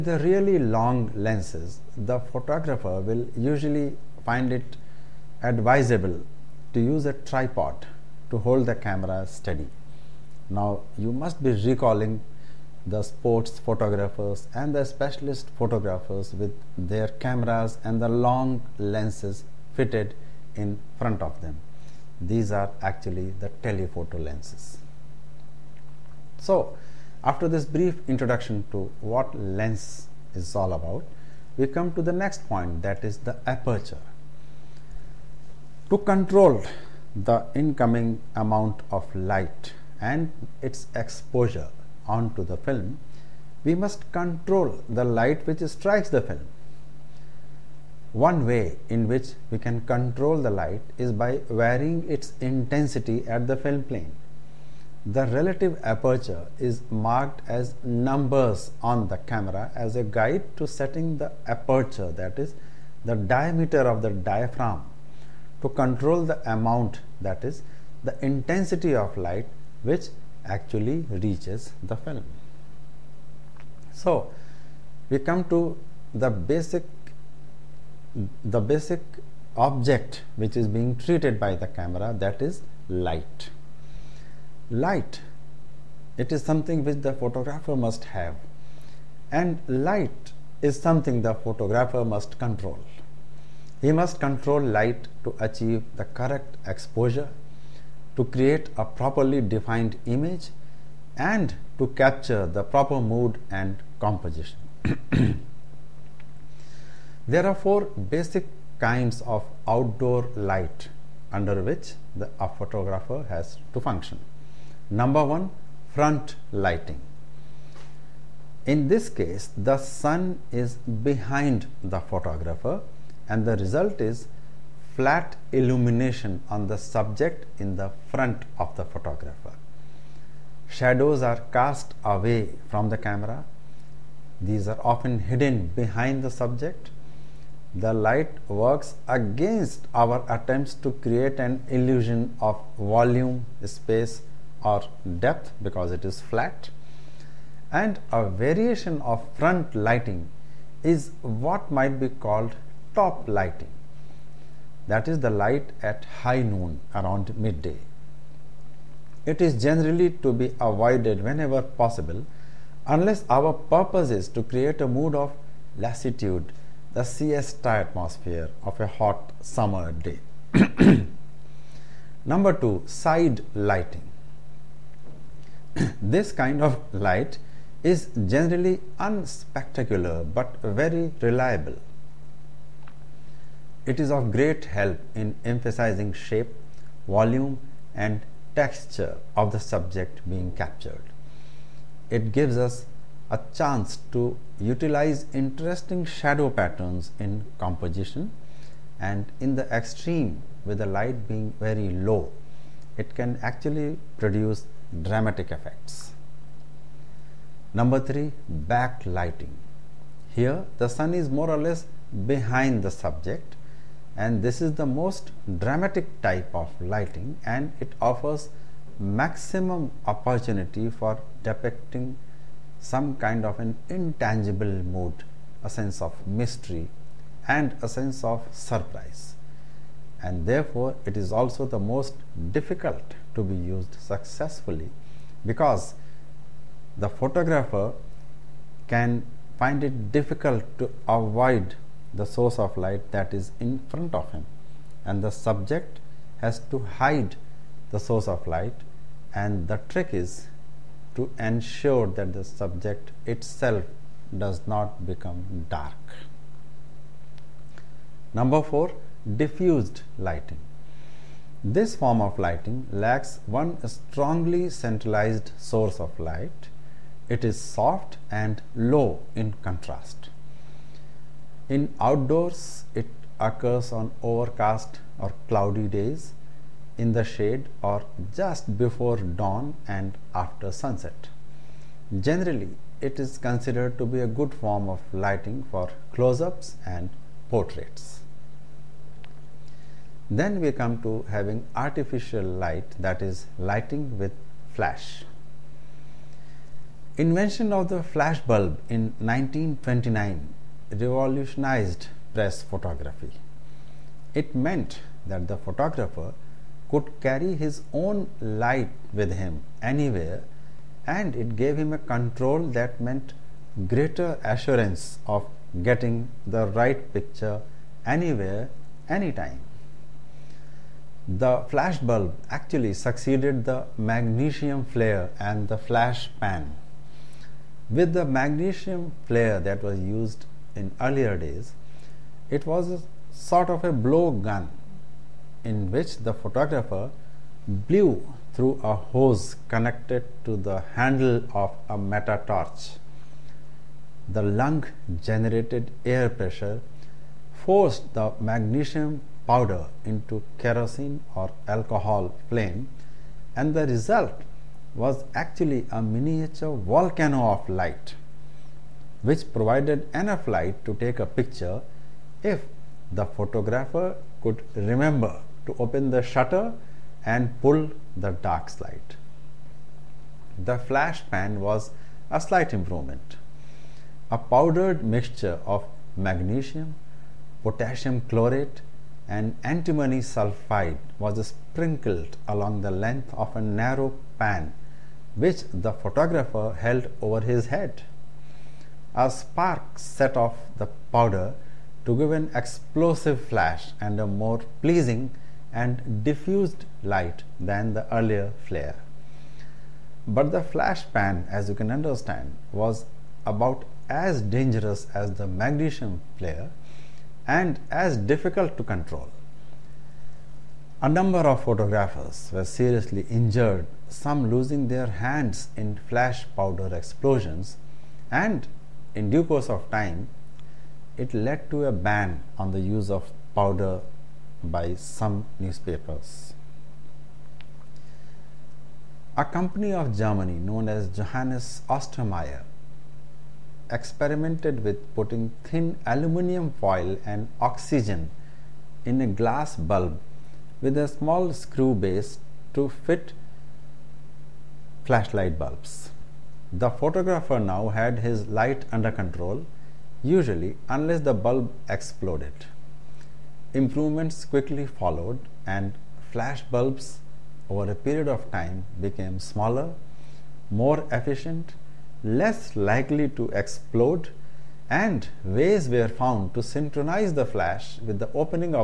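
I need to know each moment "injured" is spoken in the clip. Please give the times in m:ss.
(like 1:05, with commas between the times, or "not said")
6:53.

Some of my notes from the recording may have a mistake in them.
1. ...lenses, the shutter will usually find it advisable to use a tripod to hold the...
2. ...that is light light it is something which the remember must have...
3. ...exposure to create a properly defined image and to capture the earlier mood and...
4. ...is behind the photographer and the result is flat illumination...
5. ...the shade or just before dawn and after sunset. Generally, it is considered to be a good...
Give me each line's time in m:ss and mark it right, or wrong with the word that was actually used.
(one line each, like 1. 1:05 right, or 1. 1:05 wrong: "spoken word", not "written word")
1. 0:01 wrong: "photographer", not "shutter"
2. 1:22 wrong: "photographer", not "remember"
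3. 1:36 wrong: "proper", not "earlier"
4. 2:00 right
5. 4:37 right.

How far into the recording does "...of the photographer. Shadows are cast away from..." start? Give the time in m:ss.
2:08.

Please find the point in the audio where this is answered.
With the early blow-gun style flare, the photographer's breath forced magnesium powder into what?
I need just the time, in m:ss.
5:50.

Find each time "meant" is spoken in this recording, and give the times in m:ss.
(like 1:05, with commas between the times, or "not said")
5:04, 5:13.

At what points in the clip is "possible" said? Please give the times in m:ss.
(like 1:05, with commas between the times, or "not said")
2:41.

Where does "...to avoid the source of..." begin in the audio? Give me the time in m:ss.
4:00.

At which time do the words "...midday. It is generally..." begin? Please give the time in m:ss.
2:37.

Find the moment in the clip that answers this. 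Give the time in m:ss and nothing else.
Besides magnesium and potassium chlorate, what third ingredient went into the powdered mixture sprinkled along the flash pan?
6:19.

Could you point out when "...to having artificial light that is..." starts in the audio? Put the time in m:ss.
4:51.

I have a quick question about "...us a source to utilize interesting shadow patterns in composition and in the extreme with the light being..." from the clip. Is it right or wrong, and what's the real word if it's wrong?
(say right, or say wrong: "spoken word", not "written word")
wrong: "chance", not "source".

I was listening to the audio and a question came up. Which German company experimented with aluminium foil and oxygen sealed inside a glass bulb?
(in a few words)
Johannes Ostermeier.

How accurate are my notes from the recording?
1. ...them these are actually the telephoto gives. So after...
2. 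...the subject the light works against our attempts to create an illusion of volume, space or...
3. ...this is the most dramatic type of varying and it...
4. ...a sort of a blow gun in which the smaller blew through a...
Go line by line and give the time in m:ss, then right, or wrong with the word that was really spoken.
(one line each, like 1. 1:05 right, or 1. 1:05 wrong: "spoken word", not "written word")
1. 0:21 wrong: "lenses", not "gives"
2. 2:16 right
3. 3:34 wrong: "lighting", not "varying"
4. 5:32 wrong: "photographer", not "smaller".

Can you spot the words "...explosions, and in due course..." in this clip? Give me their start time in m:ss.
6:56.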